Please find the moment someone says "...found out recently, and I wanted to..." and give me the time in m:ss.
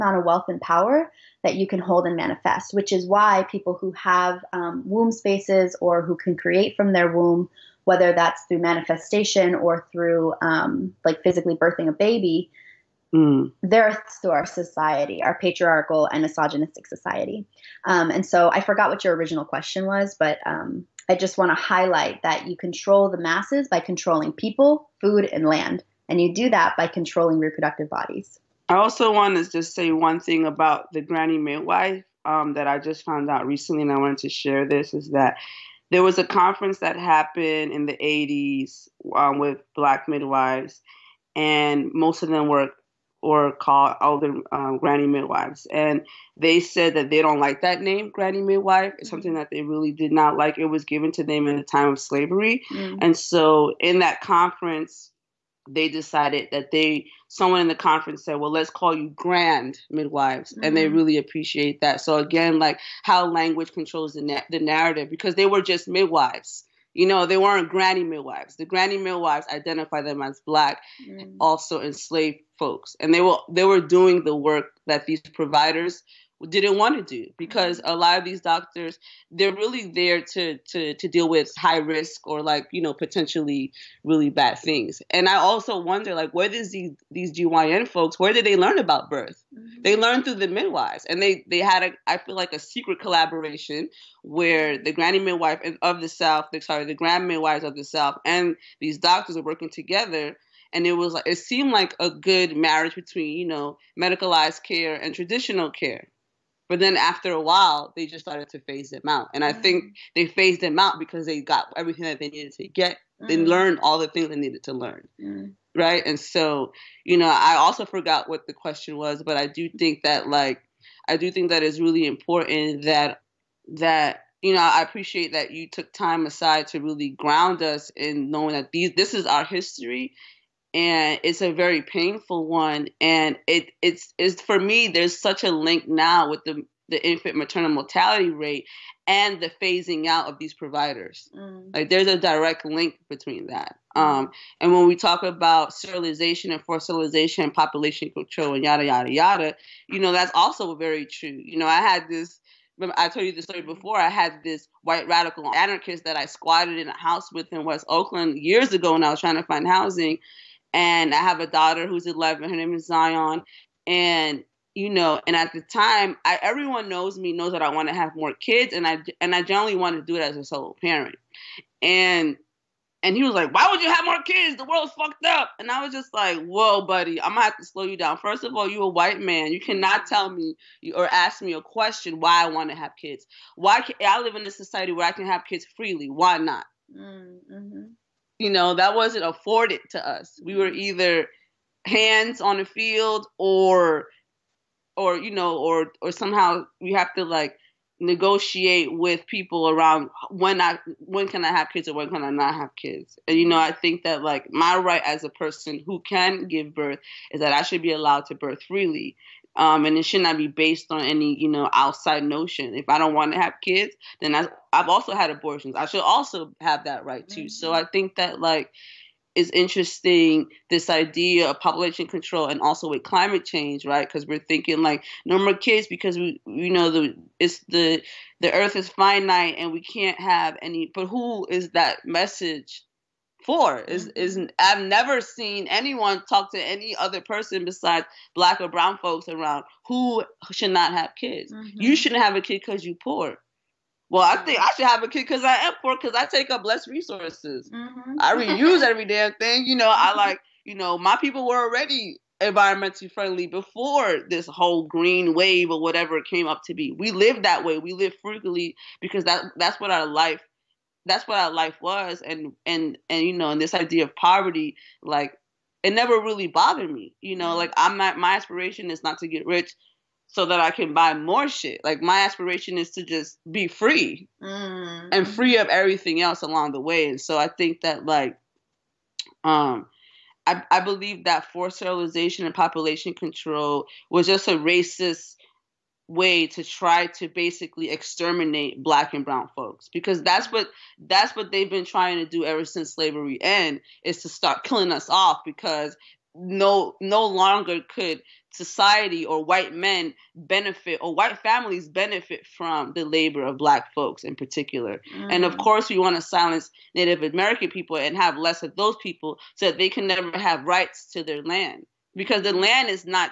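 0:33.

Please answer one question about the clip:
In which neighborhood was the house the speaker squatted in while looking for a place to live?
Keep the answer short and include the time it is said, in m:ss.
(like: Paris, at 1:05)
West Oakland, at 2:37.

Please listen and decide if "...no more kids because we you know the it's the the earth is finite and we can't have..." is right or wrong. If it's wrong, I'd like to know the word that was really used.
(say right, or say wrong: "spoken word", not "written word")
right.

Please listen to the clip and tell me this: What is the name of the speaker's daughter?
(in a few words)
Zion.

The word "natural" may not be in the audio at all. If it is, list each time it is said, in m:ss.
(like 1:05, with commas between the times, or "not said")
not said.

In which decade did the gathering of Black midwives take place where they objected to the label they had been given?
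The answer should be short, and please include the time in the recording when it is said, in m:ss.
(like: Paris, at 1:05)
1980s, at 0:37.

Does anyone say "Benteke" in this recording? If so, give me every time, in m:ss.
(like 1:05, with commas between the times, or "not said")
not said.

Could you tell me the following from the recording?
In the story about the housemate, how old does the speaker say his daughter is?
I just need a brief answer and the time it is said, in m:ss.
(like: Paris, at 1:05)
11, at 2:42.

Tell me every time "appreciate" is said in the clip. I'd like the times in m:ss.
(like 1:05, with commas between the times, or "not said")
1:01, 2:04.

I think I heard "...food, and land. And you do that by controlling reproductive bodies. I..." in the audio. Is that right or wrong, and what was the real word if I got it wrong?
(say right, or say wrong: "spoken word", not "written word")
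right.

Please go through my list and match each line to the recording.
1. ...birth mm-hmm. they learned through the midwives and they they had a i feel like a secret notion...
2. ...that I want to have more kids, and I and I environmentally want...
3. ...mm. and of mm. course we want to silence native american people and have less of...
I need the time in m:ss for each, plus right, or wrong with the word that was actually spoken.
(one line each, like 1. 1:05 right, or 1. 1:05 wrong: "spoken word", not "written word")
1. 1:29 wrong: "collaboration", not "notion"
2. 2:47 wrong: "generally", not "environmentally"
3. 5:05 right.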